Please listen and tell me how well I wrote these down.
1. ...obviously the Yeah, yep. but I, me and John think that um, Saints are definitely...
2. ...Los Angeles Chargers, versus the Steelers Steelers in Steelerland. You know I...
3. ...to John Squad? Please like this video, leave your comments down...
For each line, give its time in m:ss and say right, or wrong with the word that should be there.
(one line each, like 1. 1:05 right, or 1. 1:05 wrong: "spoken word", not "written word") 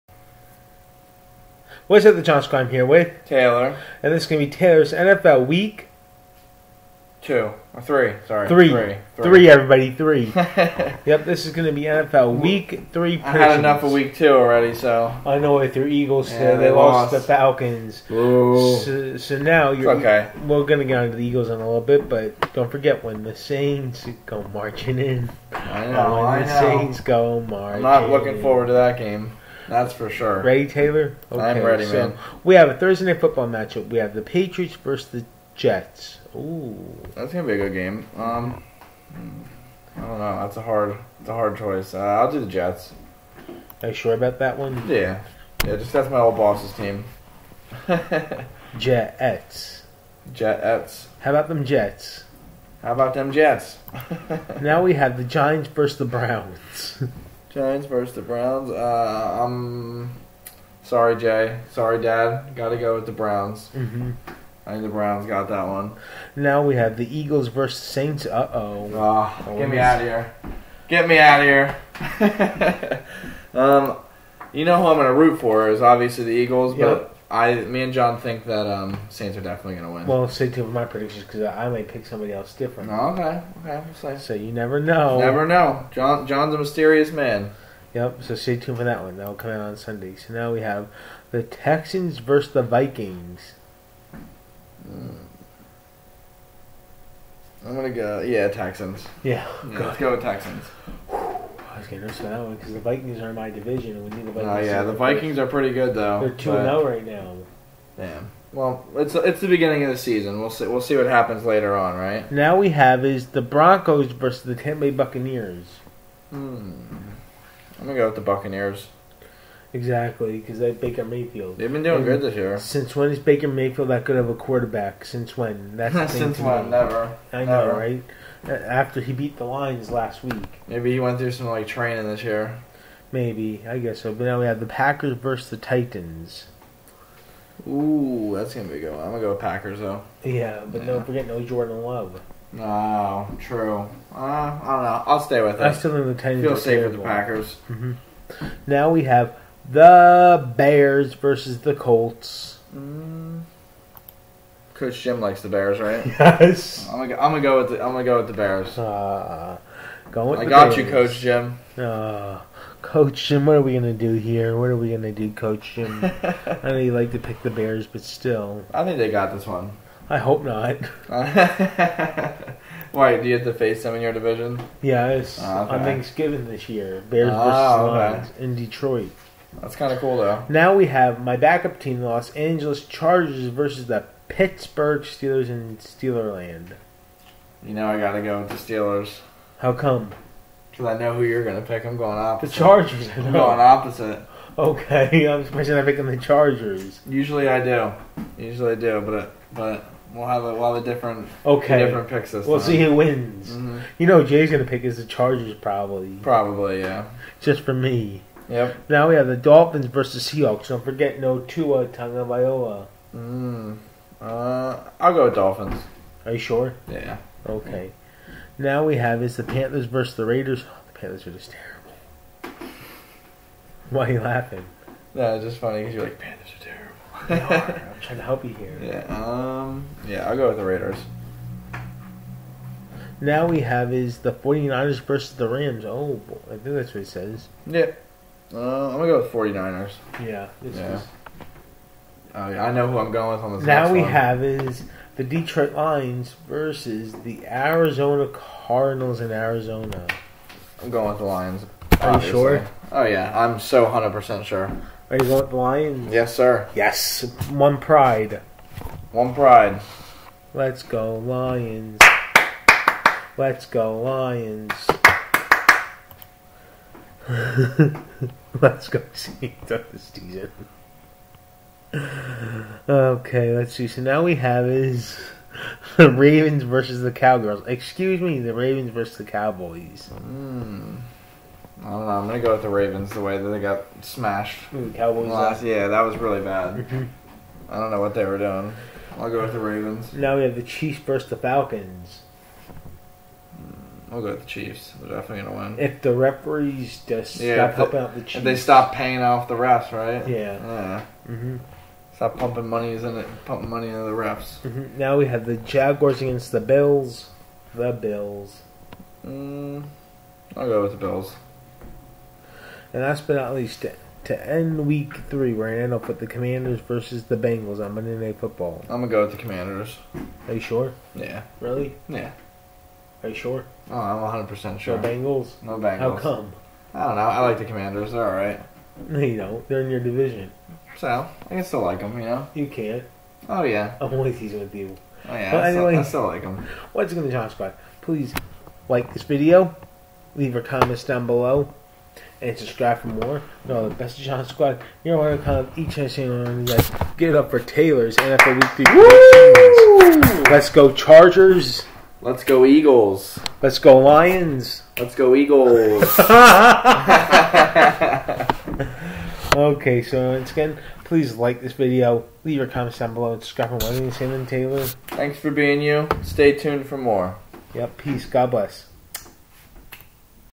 1. 1:15 wrong: "Eagles", not "Yeah"
2. 3:02 wrong: "Pittsburgh", not "Steelers"
3. 5:37 right.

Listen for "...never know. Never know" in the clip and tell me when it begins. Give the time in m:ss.
1:24.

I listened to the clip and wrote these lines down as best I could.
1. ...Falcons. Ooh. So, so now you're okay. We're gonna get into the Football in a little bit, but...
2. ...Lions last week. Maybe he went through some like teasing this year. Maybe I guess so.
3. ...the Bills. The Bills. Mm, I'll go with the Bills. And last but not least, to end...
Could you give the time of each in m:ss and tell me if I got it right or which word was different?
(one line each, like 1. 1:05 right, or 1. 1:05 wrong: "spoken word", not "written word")
1. 0:17 wrong: "Eagles", not "Football"
2. 2:09 wrong: "training", not "teasing"
3. 5:06 right.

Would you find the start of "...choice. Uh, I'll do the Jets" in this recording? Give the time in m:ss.
0:41.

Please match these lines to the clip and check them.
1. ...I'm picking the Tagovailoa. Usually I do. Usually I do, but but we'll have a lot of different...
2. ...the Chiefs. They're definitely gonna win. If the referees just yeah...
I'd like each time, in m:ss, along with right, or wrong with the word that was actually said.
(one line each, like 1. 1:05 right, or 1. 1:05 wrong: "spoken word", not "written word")
1. 3:15 wrong: "Chargers", not "Tagovailoa"
2. 4:54 right.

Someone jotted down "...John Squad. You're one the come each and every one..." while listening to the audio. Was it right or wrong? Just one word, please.
right.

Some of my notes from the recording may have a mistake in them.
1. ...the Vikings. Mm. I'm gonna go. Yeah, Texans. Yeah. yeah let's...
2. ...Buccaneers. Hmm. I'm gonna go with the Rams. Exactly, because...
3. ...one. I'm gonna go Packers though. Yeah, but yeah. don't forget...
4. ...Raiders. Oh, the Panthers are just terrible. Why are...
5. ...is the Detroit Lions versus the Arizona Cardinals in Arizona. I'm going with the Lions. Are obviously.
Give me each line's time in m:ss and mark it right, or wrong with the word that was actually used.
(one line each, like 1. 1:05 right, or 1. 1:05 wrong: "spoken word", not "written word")
1. 1:32 right
2. 1:54 wrong: "Buccaneers", not "Rams"
3. 2:18 right
4. 3:40 right
5. 4:04 right.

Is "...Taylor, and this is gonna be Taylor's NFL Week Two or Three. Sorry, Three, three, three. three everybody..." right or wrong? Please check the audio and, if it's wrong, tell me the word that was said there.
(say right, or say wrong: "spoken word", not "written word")
right.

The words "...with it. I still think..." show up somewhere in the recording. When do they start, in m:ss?
2:25.